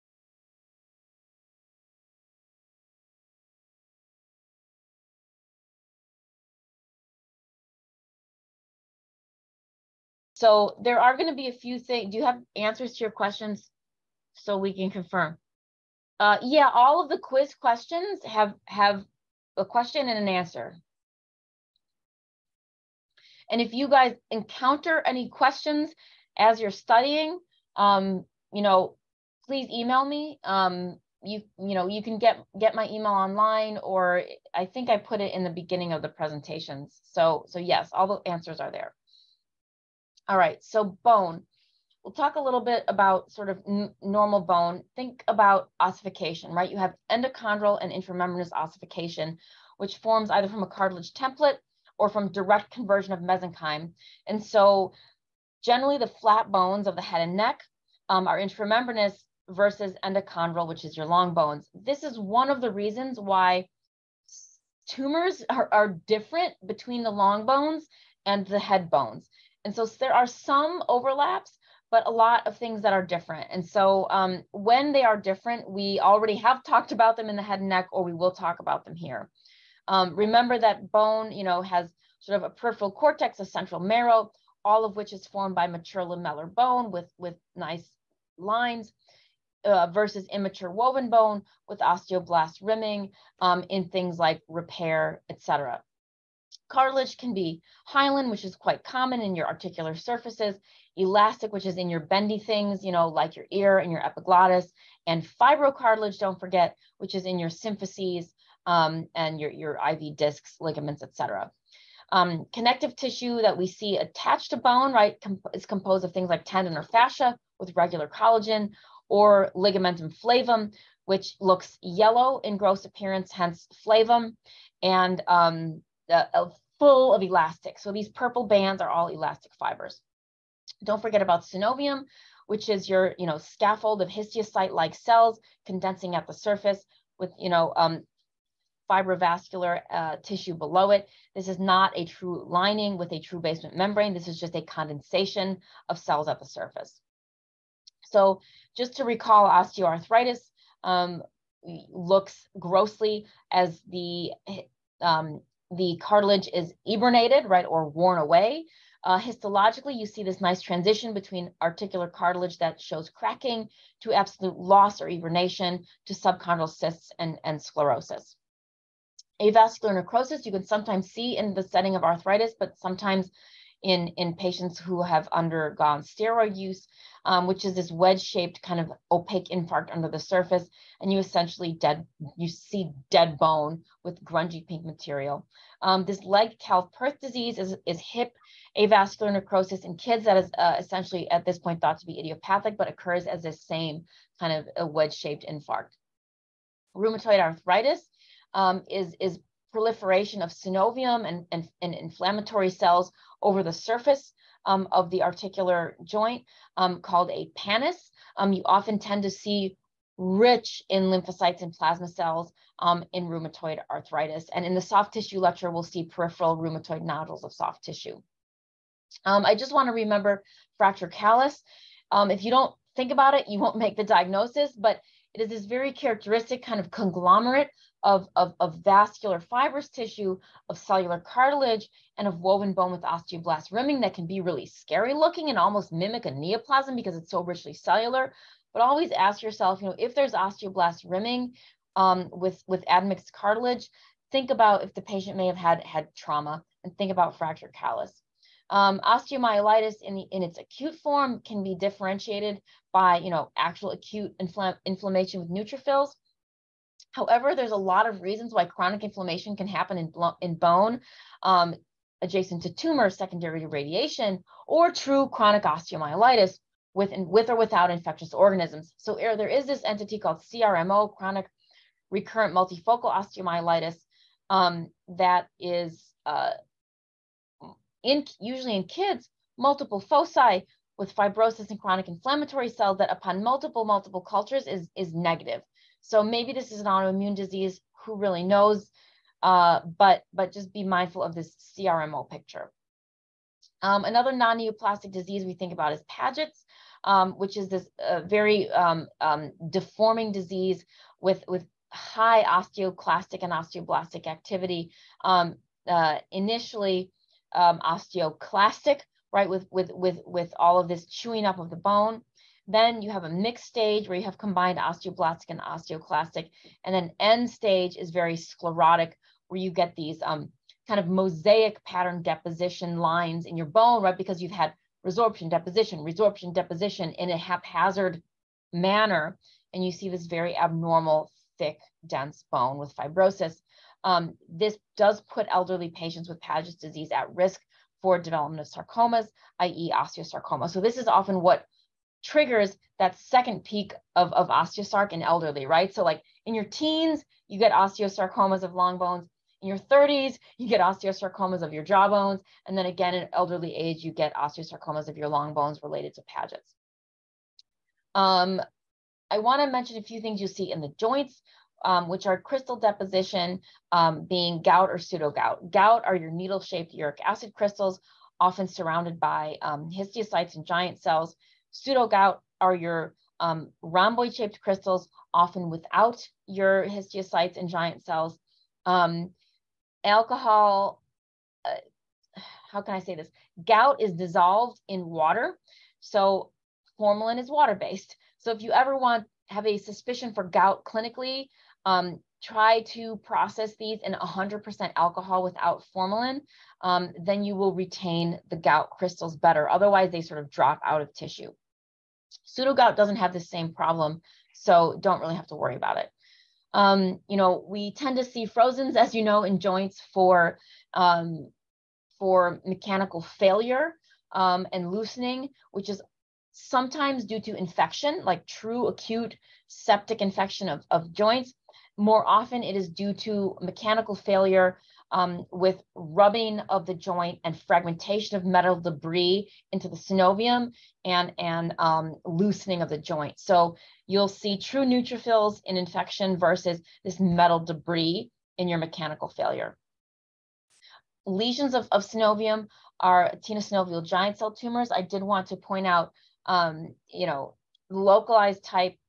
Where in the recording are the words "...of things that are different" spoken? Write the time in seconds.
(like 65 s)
72 s.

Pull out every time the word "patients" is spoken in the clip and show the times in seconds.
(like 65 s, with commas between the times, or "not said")
174 s, 245 s, 335 s.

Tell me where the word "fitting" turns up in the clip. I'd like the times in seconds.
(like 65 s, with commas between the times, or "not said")
not said.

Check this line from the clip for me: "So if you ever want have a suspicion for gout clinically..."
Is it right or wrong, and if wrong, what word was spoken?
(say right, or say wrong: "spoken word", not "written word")
right.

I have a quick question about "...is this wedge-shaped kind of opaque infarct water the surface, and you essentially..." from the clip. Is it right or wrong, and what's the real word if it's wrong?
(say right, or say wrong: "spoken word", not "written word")
wrong: "under", not "water".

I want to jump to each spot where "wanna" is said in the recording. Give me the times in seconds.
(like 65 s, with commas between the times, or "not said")
219 s, 359 s.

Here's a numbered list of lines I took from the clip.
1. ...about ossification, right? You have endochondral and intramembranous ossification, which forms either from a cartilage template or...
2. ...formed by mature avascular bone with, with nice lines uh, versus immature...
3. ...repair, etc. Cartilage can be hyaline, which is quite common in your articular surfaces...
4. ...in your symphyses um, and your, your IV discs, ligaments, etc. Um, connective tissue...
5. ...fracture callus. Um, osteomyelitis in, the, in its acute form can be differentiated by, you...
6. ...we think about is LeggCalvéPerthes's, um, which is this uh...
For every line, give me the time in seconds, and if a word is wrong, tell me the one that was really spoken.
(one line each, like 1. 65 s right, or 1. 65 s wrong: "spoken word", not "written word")
1. 45 s right
2. 85 s wrong: "lamellar", not "avascular"
3. 94 s right
4. 107 s right
5. 247 s right
6. 295 s wrong: "Paget", not "LeggCalvéPerthes".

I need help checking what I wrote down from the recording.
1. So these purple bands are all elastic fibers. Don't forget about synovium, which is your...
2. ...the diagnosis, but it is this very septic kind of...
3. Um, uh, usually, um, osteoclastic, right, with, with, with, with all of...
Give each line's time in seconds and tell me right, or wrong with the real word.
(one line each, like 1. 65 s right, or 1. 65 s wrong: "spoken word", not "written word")
1. 127 s right
2. 223 s wrong: "characteristic", not "septic"
3. 305 s wrong: "initially", not "usually".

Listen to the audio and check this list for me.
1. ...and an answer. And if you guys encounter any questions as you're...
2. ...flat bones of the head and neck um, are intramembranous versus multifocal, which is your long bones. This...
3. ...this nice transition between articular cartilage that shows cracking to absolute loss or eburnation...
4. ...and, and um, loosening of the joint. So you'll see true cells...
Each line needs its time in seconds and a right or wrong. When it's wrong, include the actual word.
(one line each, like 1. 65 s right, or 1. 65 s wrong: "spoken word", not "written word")
1. 20 s right
2. 56 s wrong: "endochondral", not "multifocal"
3. 160 s right
4. 431 s wrong: "neutrophils", not "cells".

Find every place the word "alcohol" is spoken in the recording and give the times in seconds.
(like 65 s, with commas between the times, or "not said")
380 s, 394 s.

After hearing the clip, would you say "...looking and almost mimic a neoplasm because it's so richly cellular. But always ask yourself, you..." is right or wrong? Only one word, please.
right.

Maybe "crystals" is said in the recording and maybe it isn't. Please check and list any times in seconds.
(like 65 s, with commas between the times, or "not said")
362 s, 367 s, 374 s, 398 s.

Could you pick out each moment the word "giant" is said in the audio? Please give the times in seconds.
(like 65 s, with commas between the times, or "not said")
370 s, 377 s, 444 s.